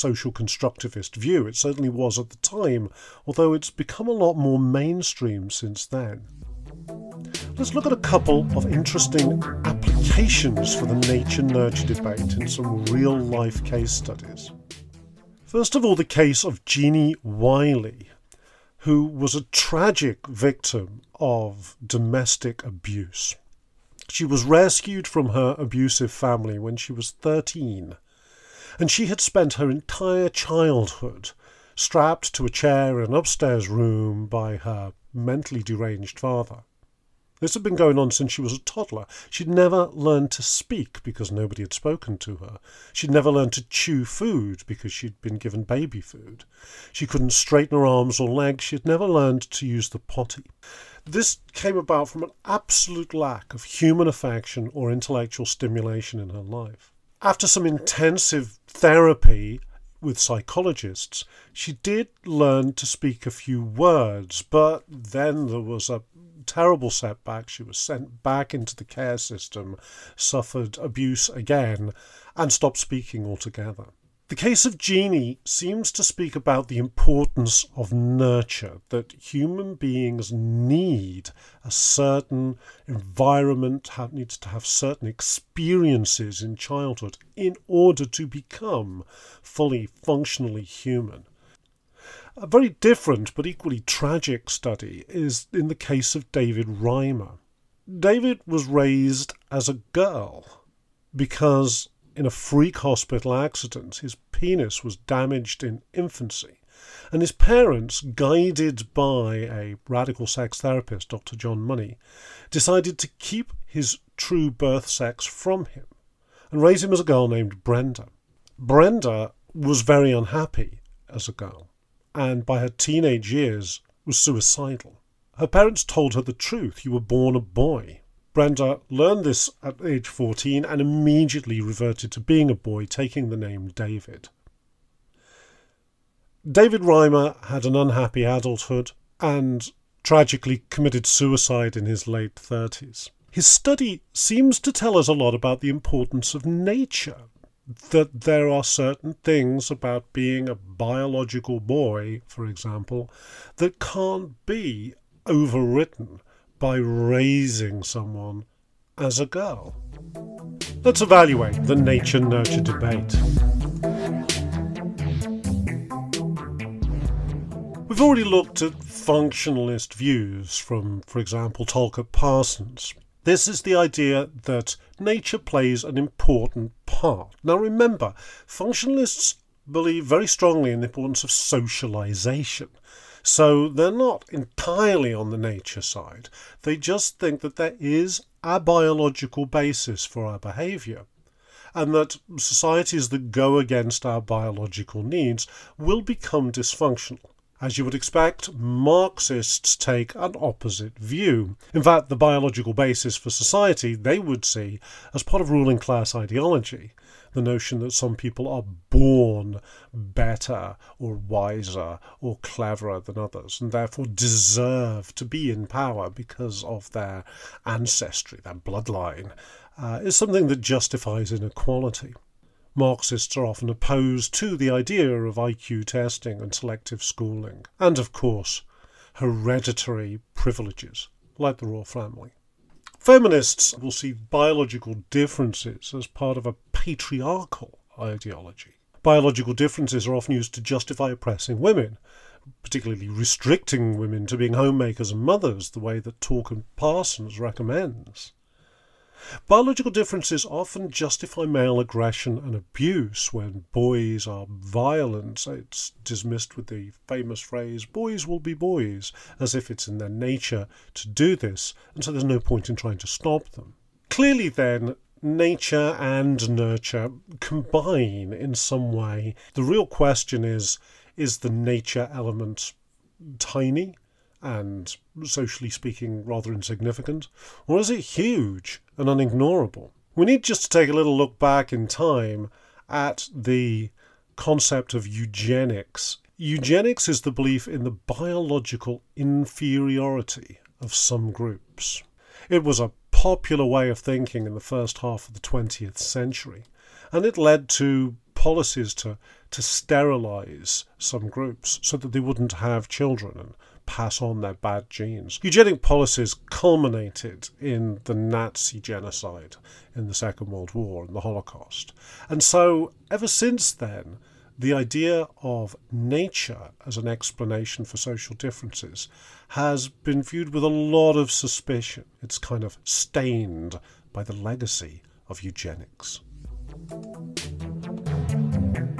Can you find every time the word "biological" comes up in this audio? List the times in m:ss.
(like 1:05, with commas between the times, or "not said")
2:30, 3:08, 3:14, 3:22, 3:54, 3:59, 4:09, 4:47.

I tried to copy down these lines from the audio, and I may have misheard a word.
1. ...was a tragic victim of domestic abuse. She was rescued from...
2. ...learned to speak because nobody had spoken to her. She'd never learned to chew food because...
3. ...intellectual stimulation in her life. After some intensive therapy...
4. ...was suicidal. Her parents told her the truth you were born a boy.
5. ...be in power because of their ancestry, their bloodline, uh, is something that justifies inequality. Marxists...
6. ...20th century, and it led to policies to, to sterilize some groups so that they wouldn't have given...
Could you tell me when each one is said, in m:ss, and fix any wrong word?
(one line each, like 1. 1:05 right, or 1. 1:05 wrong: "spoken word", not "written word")
1. 0:19 right
2. 0:39 right
3. 0:54 right
4. 2:04 right
5. 3:35 right
6. 4:55 wrong: "children", not "given".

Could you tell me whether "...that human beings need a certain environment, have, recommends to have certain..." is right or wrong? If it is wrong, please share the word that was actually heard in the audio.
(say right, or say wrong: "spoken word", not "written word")
wrong: "needs", not "recommends".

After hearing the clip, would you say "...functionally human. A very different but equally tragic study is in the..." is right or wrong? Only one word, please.
right.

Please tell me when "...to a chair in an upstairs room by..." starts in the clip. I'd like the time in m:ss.
0:32.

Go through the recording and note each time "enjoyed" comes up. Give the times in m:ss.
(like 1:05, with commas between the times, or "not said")
not said.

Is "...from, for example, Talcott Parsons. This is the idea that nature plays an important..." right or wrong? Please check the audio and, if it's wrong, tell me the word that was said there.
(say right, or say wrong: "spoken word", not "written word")
right.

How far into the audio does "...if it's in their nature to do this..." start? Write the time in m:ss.
4:19.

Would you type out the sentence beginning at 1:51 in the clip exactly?
John Money, decided to keep his true birth sex from him and raise him as a girl named Brenda.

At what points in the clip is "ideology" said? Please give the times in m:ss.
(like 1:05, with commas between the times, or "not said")
3:26, 3:57.